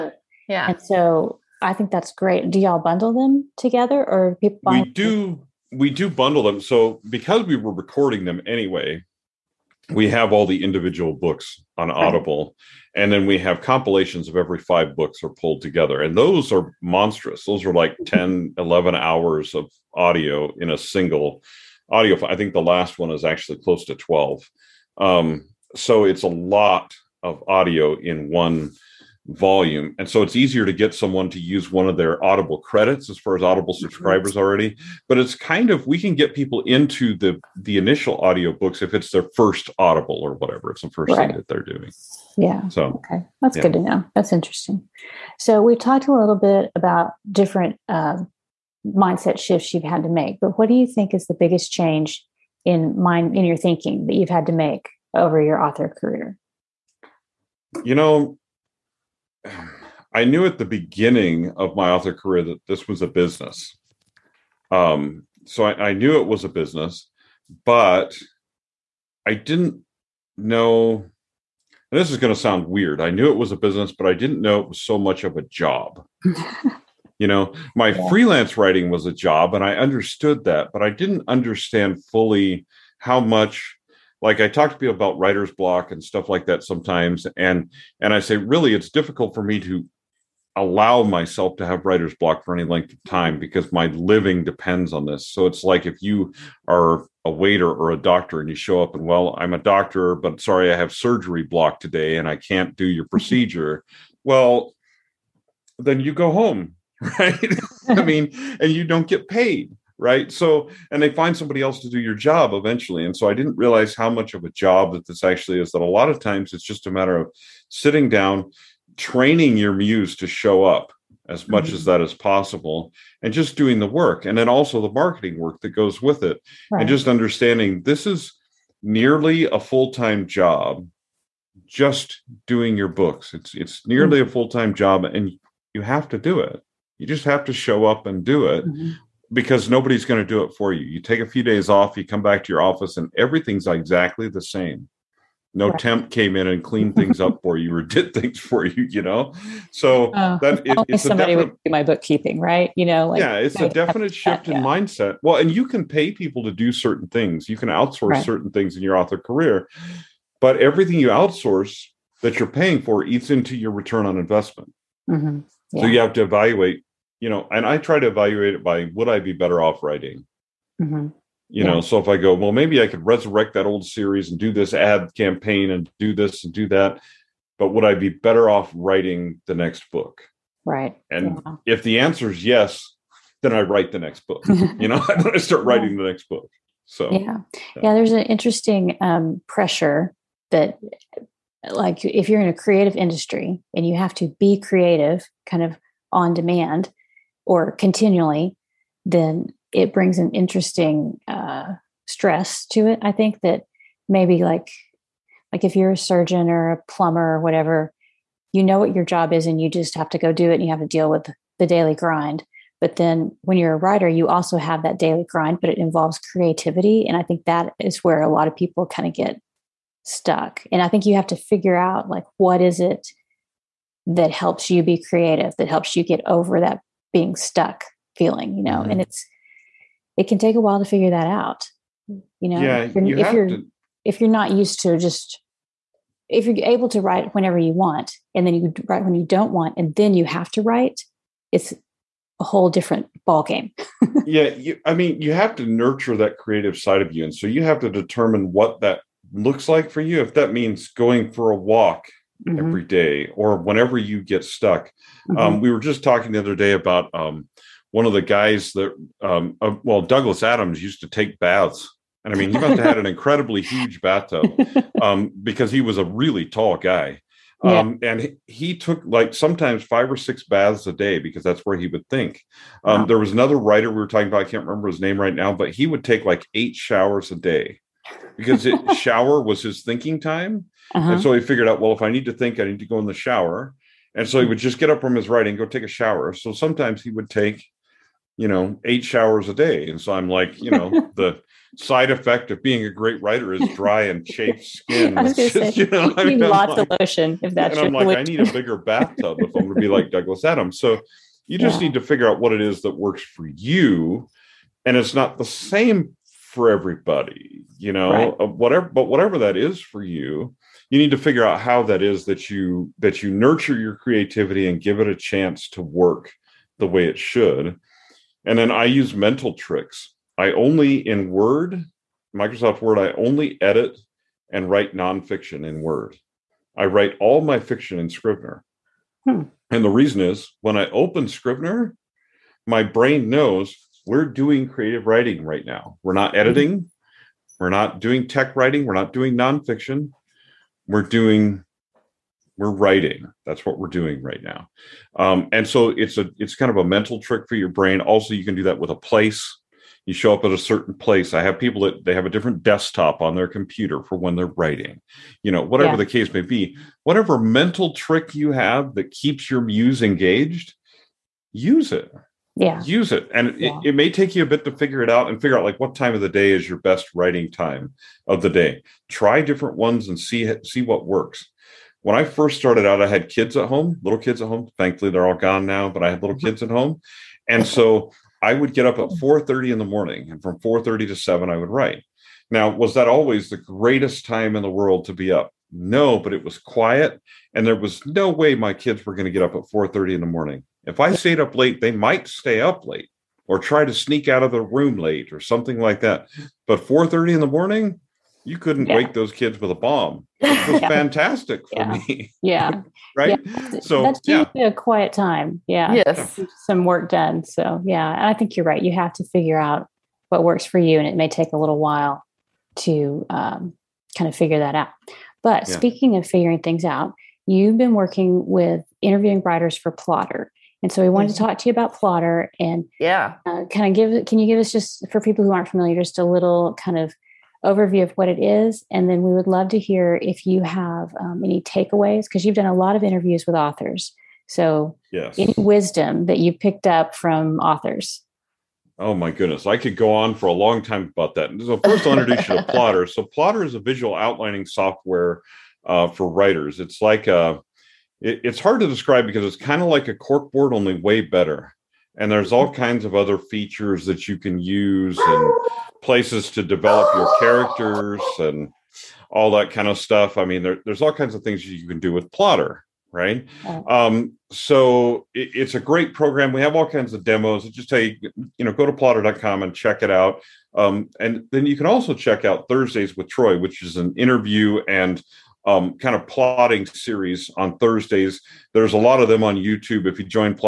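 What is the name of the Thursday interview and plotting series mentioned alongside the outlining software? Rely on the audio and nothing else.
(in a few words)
Thursdays with Troy.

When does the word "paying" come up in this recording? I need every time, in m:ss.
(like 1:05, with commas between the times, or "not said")
2:42.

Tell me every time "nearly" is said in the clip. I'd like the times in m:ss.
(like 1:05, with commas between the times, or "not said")
2:08, 2:13.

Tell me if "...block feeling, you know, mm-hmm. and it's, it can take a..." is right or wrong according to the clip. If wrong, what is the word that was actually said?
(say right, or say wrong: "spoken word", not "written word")
wrong: "stuck", not "block".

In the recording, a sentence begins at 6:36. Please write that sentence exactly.
But 4:30 in the morning, you couldn't yeah.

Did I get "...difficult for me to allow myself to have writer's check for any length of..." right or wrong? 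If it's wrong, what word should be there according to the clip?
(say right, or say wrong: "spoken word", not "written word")
wrong: "block", not "check".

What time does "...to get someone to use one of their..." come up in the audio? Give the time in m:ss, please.
0:30.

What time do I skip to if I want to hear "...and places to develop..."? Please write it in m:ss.
7:35.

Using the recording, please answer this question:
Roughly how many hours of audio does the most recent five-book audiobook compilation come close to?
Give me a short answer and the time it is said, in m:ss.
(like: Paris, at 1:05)
12, at 0:23.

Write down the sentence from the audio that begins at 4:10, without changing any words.
If that means going for a walk mm-hmm.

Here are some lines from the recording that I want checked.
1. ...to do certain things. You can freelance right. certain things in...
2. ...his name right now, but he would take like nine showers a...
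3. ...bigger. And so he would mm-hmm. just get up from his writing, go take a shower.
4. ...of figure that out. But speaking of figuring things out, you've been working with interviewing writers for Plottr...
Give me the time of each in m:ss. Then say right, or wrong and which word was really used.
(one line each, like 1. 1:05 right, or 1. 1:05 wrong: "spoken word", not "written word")
1. 2:36 wrong: "outsource", not "freelance"
2. 4:34 wrong: "eight", not "nine"
3. 4:43 wrong: "shower", not "bigger"
4. 6:54 right.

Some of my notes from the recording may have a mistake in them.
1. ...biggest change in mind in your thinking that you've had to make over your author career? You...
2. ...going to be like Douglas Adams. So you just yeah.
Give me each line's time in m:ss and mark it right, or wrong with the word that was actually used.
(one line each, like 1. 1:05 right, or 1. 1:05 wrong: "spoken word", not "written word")
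1. 0:51 right
2. 4:59 right.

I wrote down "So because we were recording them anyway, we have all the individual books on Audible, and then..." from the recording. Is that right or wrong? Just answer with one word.
right.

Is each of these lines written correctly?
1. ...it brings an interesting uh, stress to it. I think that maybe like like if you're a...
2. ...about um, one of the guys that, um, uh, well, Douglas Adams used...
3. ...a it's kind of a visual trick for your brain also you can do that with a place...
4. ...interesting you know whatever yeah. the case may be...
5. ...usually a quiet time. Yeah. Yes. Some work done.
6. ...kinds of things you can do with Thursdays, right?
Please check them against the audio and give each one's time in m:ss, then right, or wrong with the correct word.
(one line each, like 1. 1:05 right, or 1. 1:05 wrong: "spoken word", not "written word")
1. 3:19 right
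2. 4:16 right
3. 5:46 wrong: "mental", not "visual"
4. 5:54 wrong: "writing", not "interesting"
5. 6:44 right
6. 7:41 wrong: "Plottr", not "Thursdays".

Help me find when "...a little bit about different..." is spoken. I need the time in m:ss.
0:46.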